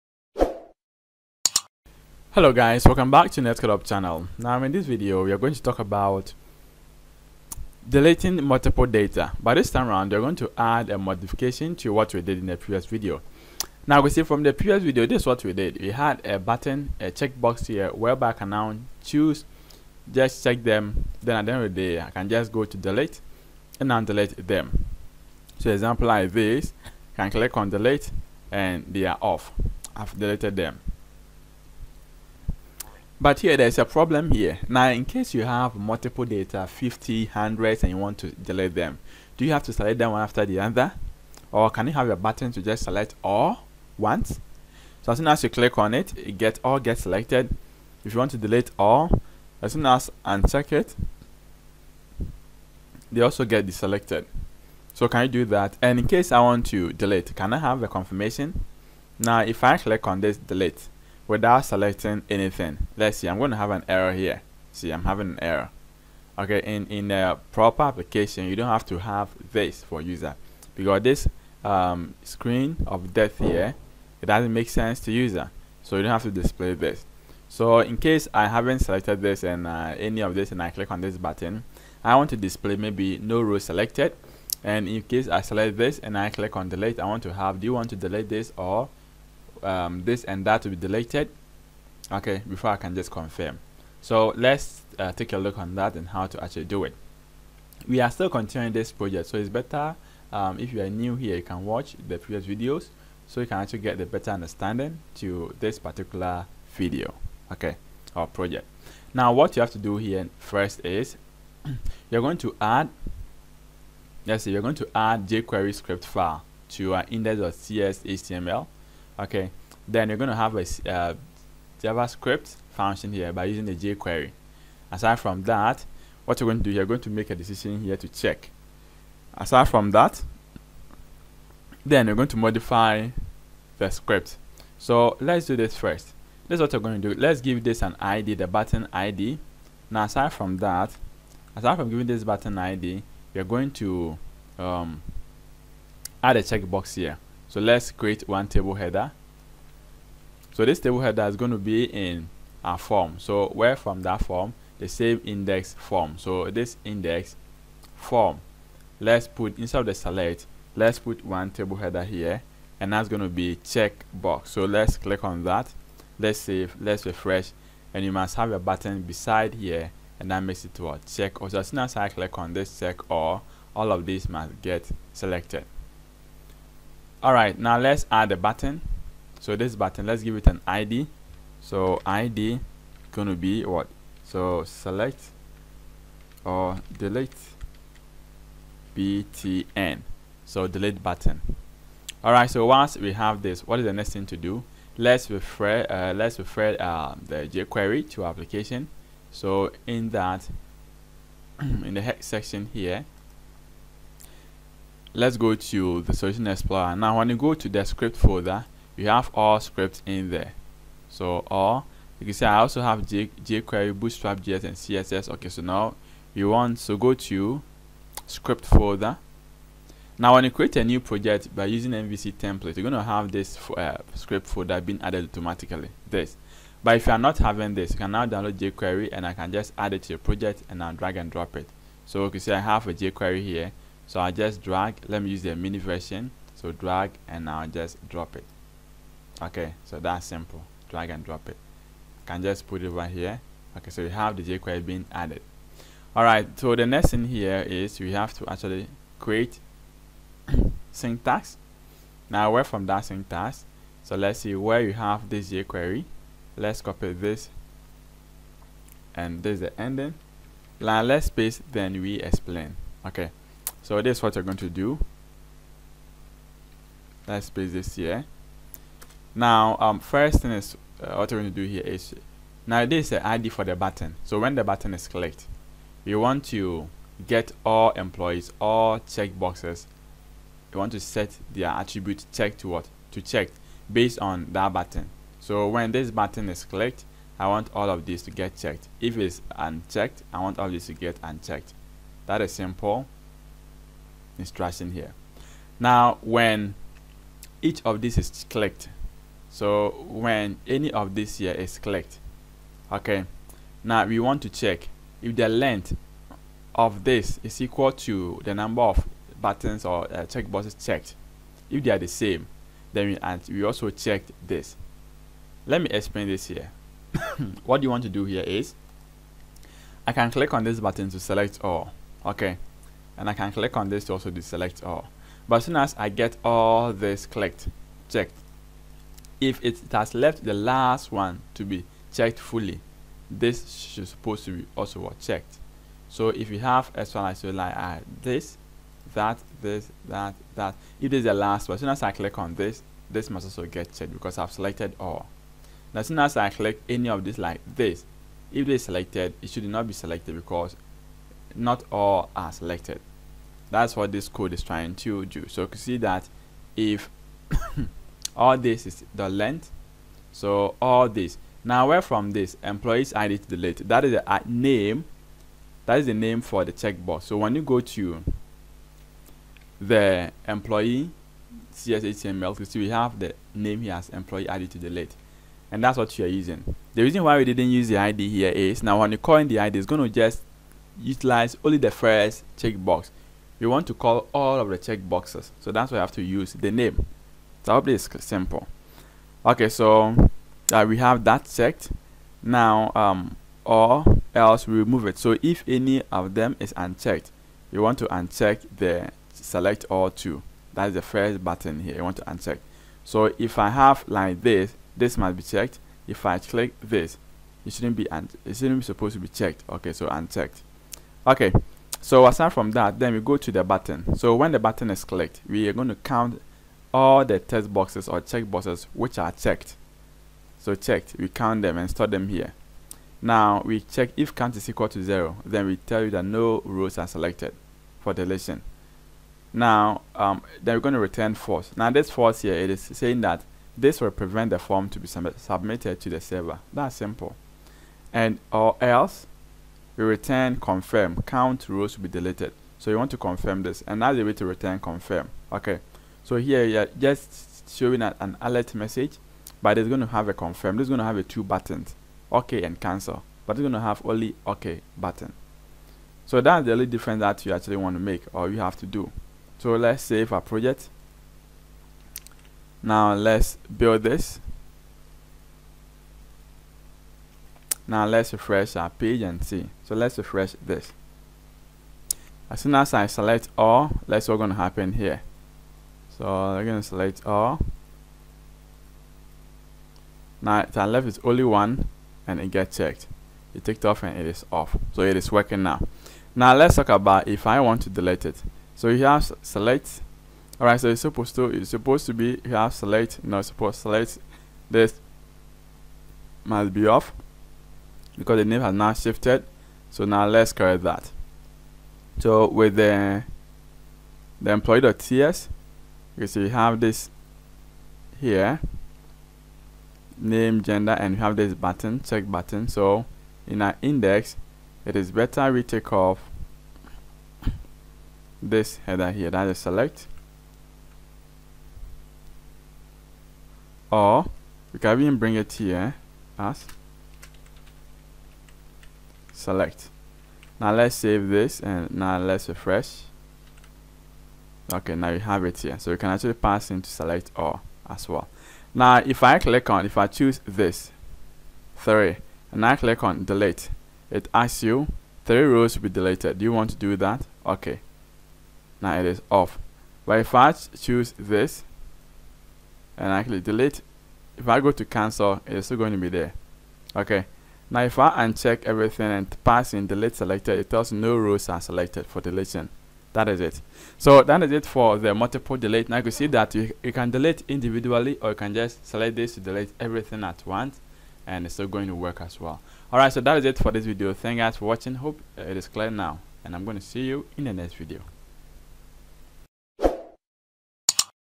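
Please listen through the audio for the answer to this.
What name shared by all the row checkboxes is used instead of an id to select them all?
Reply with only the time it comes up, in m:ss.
6:14.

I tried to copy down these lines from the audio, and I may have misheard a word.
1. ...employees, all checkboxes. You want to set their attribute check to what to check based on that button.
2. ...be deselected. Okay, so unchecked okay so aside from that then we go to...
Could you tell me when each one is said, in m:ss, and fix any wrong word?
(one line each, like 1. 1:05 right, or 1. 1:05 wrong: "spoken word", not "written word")
1. 4:37 right
2. 6:49 wrong: "checked", not "deselected".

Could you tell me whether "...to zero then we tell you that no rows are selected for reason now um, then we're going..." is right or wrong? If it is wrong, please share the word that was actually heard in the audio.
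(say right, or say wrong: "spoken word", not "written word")
wrong: "deletion", not "reason".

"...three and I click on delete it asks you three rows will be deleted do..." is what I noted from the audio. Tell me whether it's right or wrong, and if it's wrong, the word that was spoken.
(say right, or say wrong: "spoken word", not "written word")
right.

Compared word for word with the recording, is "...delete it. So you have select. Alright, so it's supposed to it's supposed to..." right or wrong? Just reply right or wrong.
right.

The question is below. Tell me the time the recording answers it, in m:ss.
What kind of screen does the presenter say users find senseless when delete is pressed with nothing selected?
1:12.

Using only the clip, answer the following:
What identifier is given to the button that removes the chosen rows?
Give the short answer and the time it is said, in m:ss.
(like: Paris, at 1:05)
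delete btn, at 3:06.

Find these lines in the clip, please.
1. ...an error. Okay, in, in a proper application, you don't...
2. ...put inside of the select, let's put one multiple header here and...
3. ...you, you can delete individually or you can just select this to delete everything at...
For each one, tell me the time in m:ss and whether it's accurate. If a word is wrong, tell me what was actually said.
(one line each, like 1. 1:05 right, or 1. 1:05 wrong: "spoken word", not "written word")
1. 1:05 right
2. 2:39 wrong: "table", not "multiple"
3. 9:26 right.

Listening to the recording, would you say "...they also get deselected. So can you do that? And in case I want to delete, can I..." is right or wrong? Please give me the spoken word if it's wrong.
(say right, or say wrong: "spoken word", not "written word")
right.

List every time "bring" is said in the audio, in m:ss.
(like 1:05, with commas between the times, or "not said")
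8:45.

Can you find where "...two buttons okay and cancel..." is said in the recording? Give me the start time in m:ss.
7:31.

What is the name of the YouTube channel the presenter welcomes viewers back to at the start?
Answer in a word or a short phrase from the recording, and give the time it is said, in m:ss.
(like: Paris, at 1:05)
Netcode Hub, at 0:03.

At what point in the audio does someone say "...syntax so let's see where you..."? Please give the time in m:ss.
4:13.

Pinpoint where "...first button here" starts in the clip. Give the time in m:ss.
6:41.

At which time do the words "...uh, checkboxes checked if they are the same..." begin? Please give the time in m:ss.
5:10.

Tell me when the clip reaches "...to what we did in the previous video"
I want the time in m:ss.
0:11.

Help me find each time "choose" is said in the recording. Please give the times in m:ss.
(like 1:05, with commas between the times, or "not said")
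0:19, 9:00, 9:10.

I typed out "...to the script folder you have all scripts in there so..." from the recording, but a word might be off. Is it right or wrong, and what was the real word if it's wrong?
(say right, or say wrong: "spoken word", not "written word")
right.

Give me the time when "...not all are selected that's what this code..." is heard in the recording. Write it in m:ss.
5:51.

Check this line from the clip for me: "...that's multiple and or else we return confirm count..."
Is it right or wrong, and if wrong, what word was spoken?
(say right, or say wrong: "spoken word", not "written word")
wrong: "simple", not "multiple".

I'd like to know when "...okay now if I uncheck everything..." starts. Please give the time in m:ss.
9:16.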